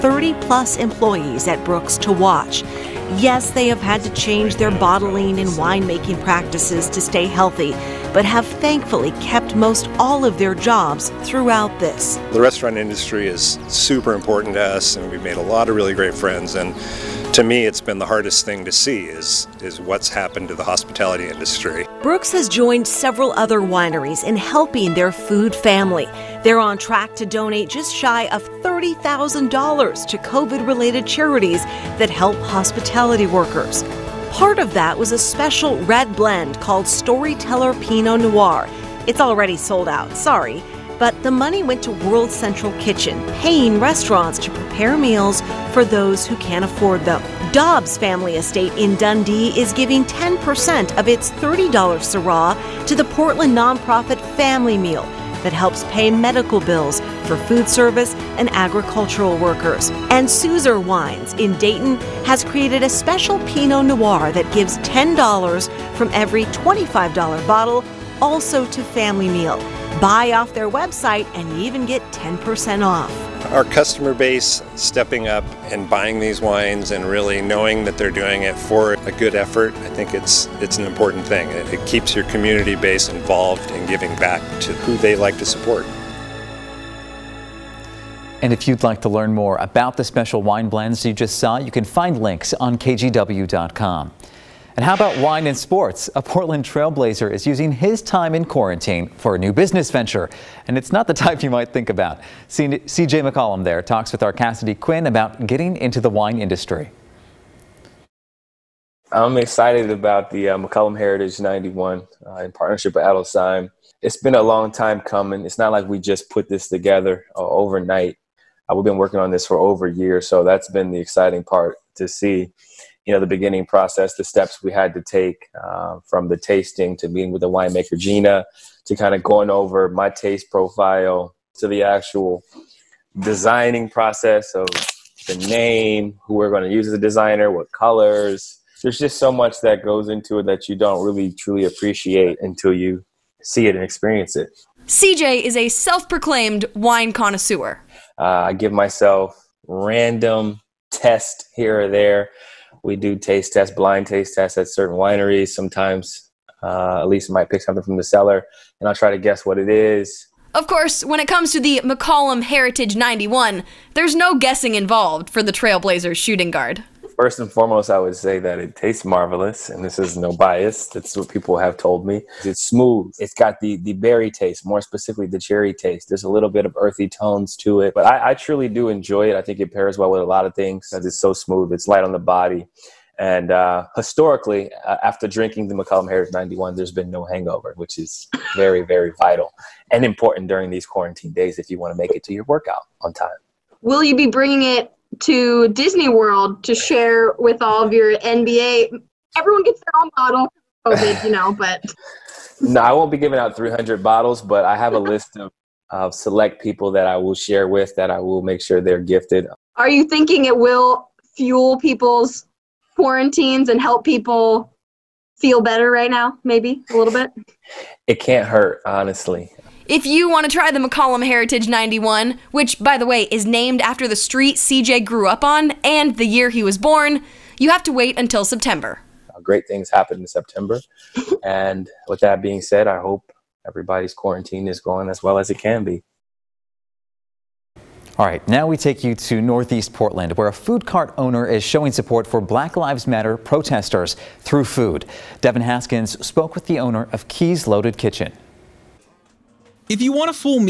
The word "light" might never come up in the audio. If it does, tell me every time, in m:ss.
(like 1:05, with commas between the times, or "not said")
3:01.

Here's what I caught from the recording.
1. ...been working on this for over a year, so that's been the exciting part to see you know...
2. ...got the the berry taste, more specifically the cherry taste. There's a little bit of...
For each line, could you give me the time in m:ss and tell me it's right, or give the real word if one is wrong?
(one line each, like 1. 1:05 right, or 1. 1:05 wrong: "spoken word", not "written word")
1. 1:58 right
2. 2:53 right.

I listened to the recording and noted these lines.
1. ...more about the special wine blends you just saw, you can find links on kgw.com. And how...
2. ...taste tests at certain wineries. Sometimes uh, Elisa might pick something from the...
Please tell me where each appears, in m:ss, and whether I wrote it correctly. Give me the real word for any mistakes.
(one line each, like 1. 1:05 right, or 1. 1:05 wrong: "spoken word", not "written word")
1. 1:29 right
2. 2:34 right.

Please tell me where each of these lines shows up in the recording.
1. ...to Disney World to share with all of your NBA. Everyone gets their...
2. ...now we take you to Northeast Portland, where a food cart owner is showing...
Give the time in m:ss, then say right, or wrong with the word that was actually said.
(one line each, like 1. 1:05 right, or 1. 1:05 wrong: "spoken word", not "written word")
1. 3:15 right
2. 3:58 right.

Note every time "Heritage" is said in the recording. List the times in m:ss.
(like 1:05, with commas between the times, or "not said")
1:50, 2:42, 3:06, 3:41.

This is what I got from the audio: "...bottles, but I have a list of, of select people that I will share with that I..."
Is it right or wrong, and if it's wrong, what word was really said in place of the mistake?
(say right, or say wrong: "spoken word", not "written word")
right.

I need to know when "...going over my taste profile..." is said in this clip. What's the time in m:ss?
2:09.